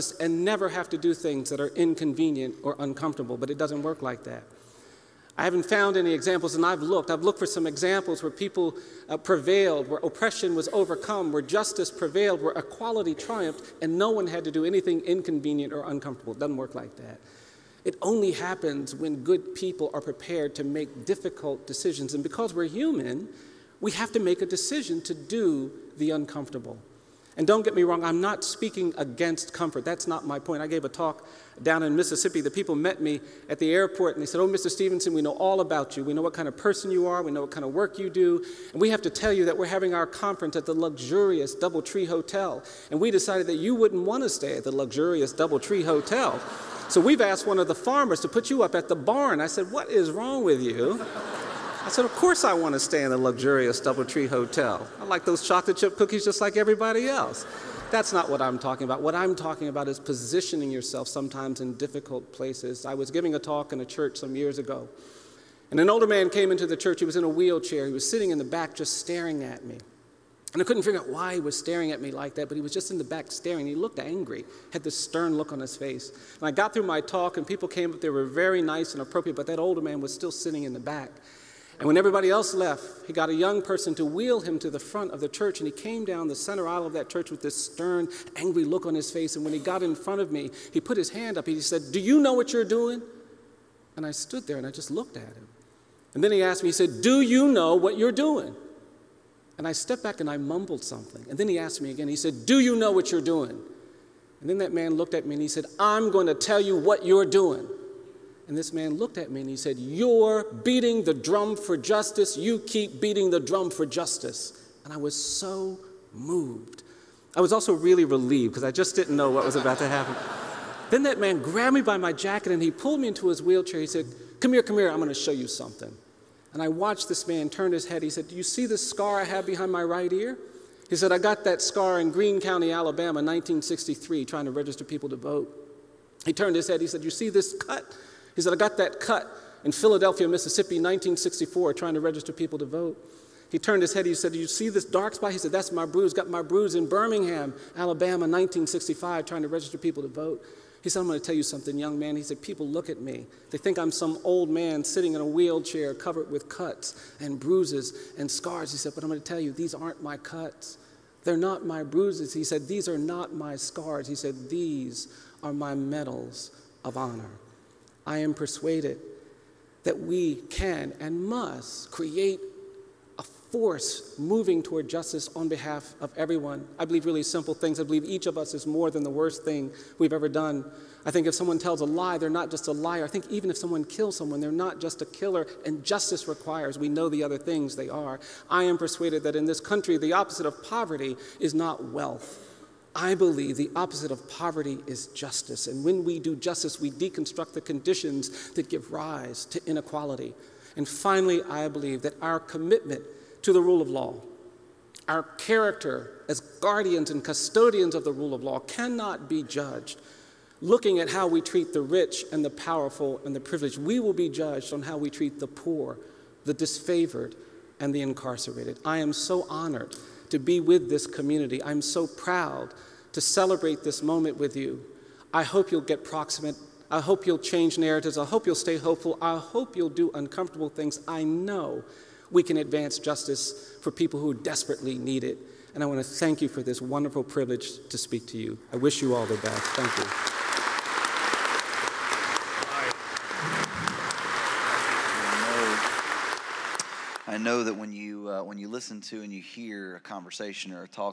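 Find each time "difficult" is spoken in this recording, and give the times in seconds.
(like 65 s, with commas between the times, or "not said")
21 s, 61 s.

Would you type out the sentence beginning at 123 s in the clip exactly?
He said, Come here, come here, I'm going to show you something.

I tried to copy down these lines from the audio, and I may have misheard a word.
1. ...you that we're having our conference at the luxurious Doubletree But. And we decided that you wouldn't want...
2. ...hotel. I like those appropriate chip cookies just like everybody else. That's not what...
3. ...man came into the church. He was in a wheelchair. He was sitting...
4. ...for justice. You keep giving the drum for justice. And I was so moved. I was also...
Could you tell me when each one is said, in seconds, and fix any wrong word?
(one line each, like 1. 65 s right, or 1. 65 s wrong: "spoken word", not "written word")
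1. 39 s wrong: "Hotel", not "But"
2. 54 s wrong: "chocolate", not "appropriate"
3. 66 s right
4. 111 s wrong: "beating", not "giving".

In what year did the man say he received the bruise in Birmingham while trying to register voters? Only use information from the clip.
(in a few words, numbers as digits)
1965.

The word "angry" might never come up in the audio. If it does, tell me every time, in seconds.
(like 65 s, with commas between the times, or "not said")
73 s, 88 s.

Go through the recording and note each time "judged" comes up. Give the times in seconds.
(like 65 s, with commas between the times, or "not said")
209 s, 214 s.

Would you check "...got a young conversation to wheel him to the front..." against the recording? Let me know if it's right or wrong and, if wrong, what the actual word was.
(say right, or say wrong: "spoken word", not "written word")
wrong: "person", not "conversation".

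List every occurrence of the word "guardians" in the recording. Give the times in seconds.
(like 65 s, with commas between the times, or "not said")
206 s.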